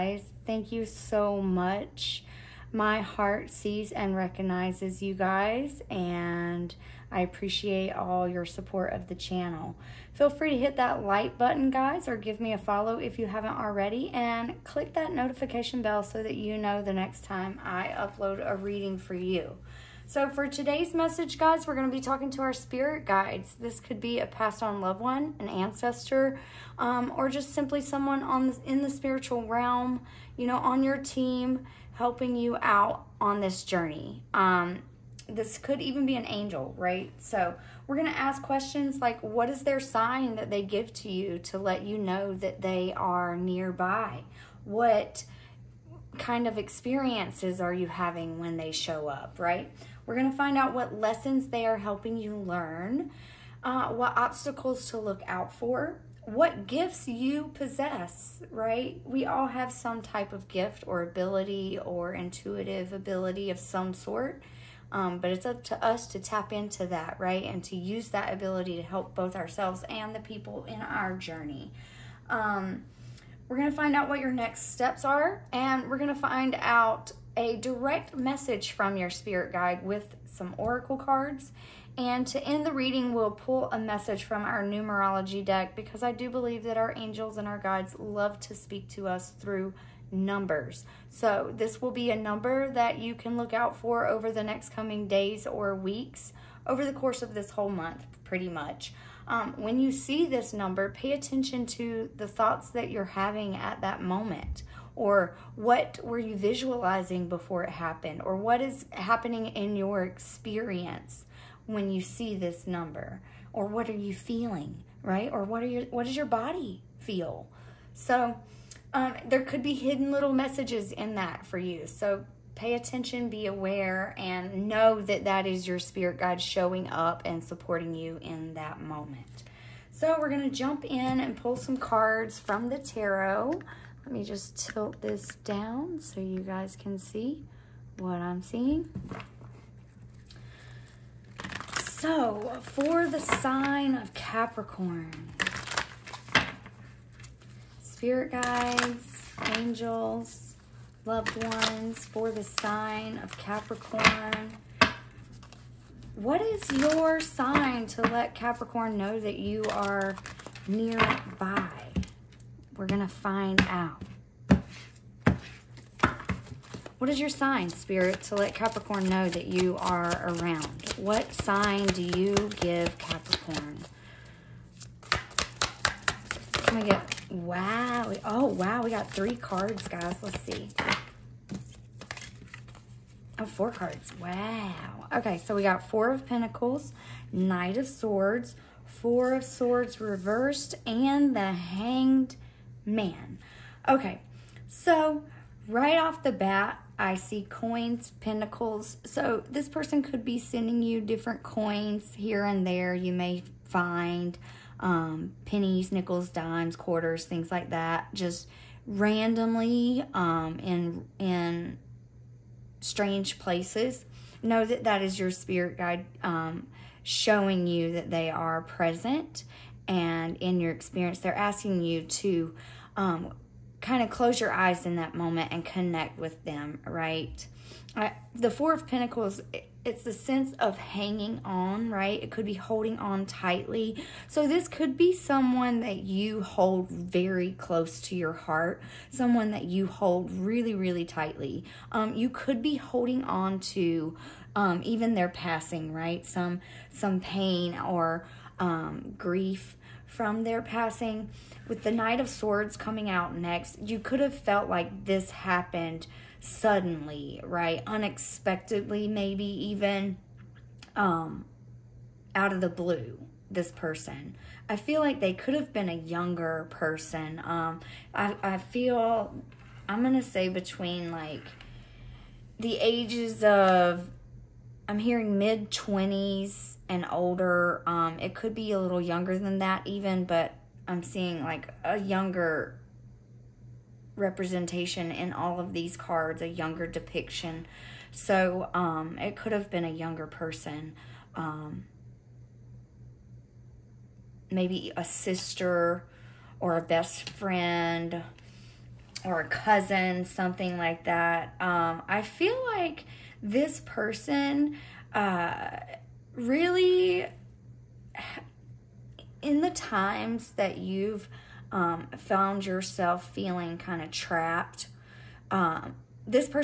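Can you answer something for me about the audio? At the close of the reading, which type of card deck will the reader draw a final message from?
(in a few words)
numerology deck.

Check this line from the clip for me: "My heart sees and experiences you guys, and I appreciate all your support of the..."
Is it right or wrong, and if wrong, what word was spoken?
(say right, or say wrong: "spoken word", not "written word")
wrong: "recognizes", not "experiences".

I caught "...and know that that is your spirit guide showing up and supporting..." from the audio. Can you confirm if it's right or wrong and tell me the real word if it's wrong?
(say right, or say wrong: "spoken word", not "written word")
right.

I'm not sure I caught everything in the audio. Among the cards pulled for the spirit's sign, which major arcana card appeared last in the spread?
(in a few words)
The Hanged Man.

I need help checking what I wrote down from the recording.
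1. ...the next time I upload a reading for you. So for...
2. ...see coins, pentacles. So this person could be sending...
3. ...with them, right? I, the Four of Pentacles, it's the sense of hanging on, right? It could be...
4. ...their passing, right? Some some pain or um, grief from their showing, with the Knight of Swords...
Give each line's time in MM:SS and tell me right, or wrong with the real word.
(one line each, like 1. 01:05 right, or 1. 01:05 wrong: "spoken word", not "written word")
1. 00:16 right
2. 03:17 right
3. 03:46 right
4. 04:05 wrong: "passing", not "showing".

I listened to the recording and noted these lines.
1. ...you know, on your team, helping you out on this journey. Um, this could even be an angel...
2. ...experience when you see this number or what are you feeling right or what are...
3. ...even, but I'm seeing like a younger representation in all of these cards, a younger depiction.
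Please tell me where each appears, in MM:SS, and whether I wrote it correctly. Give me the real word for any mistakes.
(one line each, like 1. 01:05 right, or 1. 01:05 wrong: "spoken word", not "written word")
1. 00:30 right
2. 01:50 right
3. 04:39 right.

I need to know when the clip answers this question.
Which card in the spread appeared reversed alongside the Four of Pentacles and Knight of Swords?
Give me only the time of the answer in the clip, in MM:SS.
03:08.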